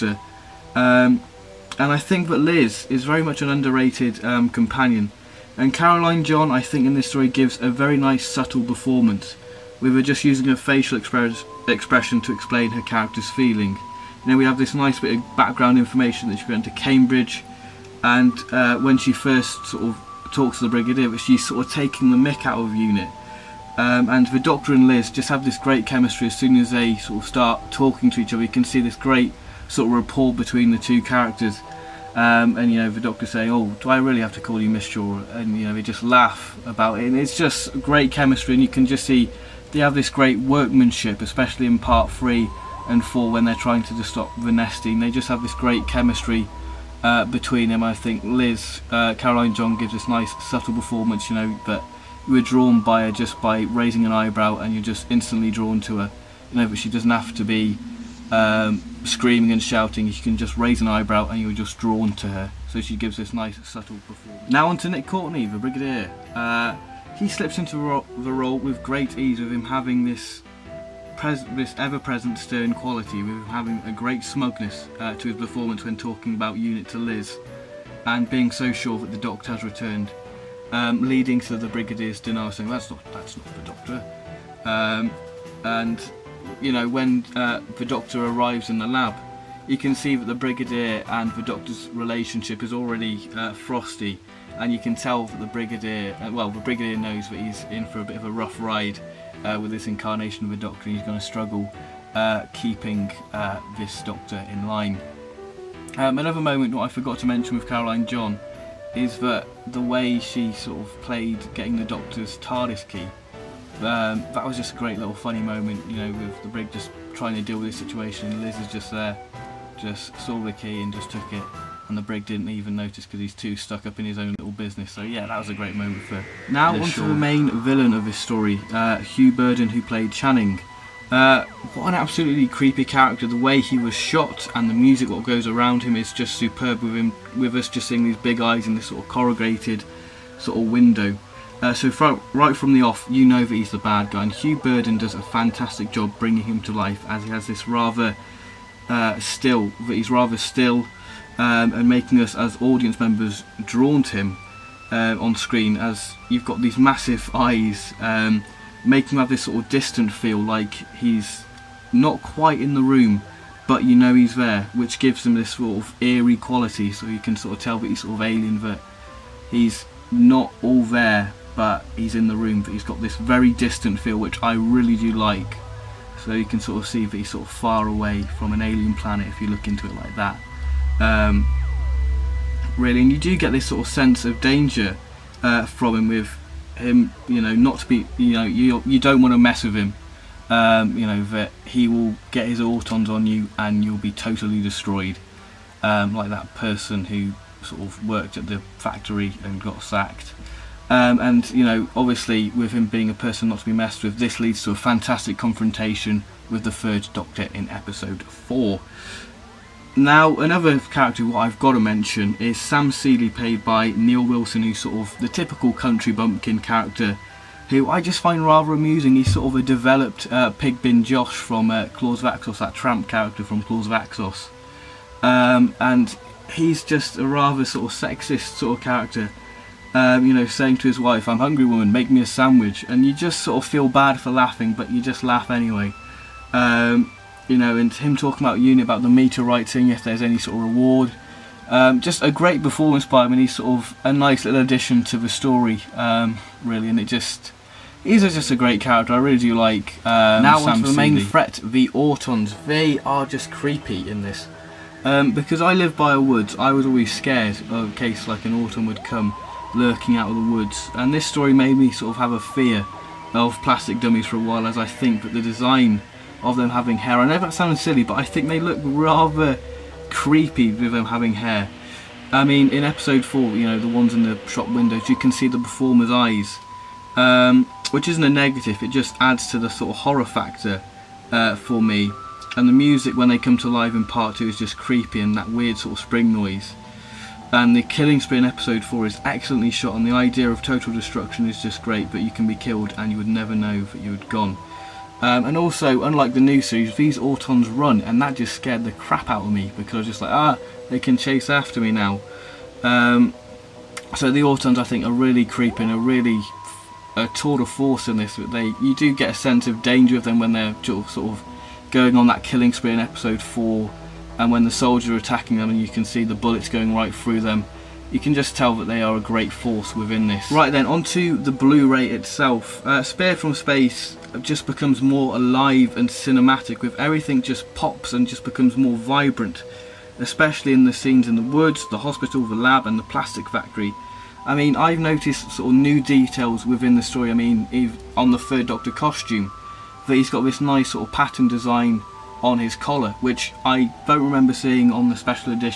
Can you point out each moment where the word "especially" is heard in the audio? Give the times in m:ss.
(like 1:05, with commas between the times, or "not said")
0:41, 5:30.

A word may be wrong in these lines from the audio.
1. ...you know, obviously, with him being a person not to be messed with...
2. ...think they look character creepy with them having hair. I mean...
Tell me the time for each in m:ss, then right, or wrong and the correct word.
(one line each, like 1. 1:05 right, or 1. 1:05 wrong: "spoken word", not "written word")
1. 3:21 right
2. 4:28 wrong: "rather", not "character".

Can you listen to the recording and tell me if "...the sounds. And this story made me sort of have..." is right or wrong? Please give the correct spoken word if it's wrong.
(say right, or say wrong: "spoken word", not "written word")
wrong: "woods", not "sounds".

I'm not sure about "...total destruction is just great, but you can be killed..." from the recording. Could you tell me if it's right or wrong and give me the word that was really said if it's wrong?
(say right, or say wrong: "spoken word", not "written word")
right.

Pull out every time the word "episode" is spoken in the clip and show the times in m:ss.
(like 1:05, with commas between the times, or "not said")
3:27, 4:32, 4:48, 5:12.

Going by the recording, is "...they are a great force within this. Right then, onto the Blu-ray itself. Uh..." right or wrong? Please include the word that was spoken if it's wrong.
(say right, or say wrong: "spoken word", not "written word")
right.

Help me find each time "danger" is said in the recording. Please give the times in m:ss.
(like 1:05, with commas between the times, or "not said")
3:04, 5:09.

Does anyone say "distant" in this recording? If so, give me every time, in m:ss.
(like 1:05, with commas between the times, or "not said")
2:39, 2:53.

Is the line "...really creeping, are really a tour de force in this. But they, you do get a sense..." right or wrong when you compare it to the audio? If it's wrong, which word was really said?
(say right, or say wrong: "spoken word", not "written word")
right.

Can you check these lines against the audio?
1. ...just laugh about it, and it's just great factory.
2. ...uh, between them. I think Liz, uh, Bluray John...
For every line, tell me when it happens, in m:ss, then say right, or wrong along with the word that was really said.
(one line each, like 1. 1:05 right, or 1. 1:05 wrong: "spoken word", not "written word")
1. 0:35 wrong: "chemistry", not "factory"
2. 0:47 wrong: "Caroline", not "Bluray".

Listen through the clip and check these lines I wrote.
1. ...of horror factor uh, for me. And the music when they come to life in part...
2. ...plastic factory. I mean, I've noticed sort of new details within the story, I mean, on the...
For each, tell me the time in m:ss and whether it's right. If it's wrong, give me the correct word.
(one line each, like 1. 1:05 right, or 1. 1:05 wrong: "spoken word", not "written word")
1. 4:39 right
2. 5:33 right.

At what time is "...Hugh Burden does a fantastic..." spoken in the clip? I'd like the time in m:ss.
2:24.